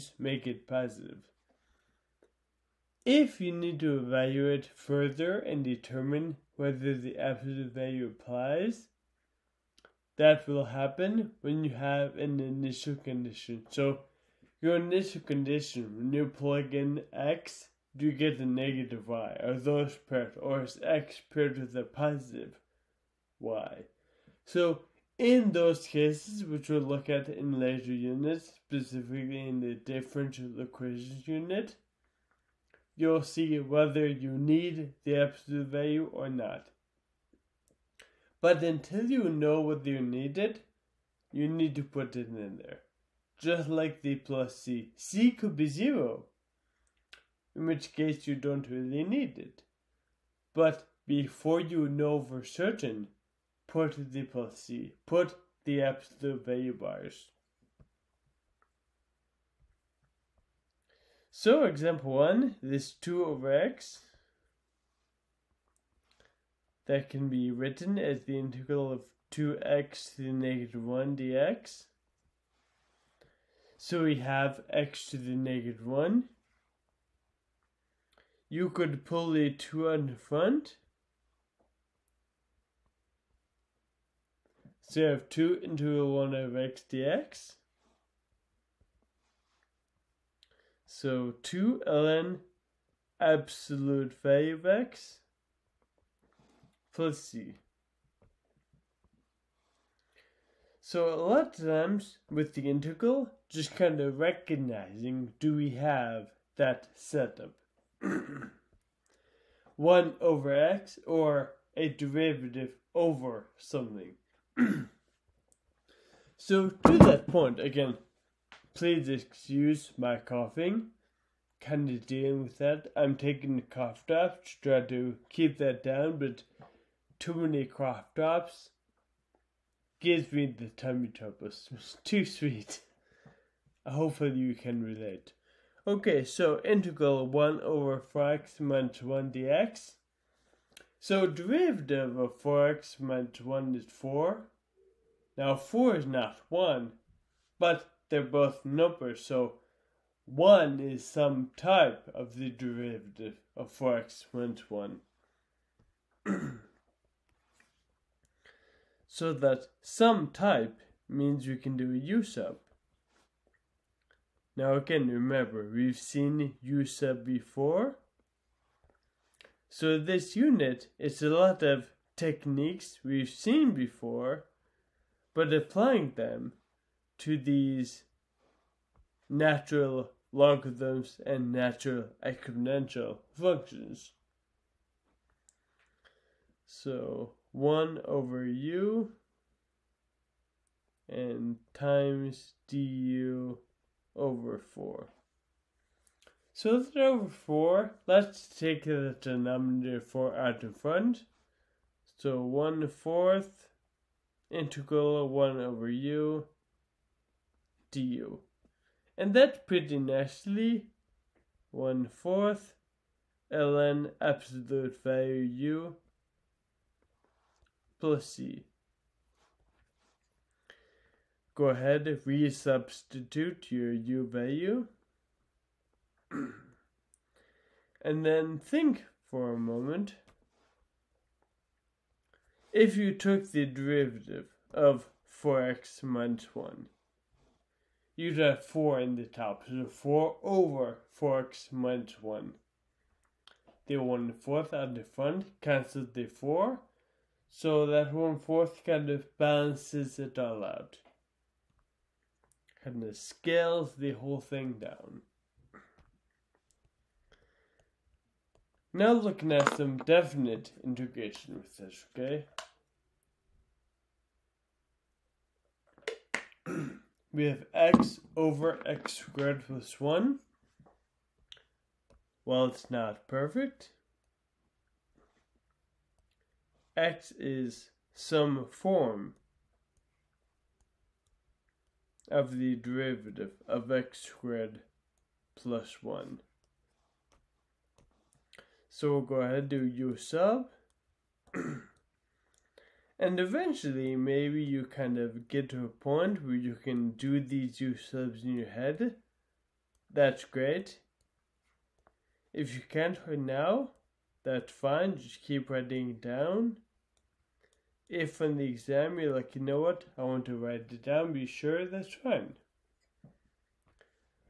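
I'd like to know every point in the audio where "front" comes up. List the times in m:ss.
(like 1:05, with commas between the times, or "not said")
1:20, 3:20, 4:05.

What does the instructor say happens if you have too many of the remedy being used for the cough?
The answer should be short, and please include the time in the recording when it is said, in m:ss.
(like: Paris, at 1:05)
tummy troubles, at 2:10.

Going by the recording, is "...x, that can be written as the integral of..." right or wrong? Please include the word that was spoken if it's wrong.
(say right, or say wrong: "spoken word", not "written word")
right.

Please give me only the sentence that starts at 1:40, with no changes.
So a lot of times with the integral, just kind of recognizing do we have that setup?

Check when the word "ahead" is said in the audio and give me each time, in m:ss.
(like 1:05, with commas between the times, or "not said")
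3:41, 4:49.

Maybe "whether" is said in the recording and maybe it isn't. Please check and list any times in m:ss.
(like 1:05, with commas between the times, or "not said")
0:06, 0:33, 0:39.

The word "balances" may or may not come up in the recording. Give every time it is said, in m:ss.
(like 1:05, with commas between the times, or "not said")
4:09.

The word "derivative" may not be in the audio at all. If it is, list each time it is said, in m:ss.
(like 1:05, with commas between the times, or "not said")
1:51, 2:21, 2:32, 3:53, 4:42.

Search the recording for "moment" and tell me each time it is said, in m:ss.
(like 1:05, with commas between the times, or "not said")
3:49.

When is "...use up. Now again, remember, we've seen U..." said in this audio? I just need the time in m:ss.
2:41.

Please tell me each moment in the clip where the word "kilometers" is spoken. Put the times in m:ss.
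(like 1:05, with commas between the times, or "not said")
not said.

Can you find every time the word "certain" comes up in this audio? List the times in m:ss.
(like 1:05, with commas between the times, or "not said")
0:52.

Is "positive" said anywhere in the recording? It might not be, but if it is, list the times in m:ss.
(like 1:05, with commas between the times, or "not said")
0:00, 0:21.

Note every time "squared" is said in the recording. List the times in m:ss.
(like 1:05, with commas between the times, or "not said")
4:29, 4:44.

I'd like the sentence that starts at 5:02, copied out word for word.
If you can't right now, that's fine.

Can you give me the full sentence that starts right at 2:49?
So this unit is a lot of techniques we've seen before, but applying them to these natural logarithms and natural exponential functions.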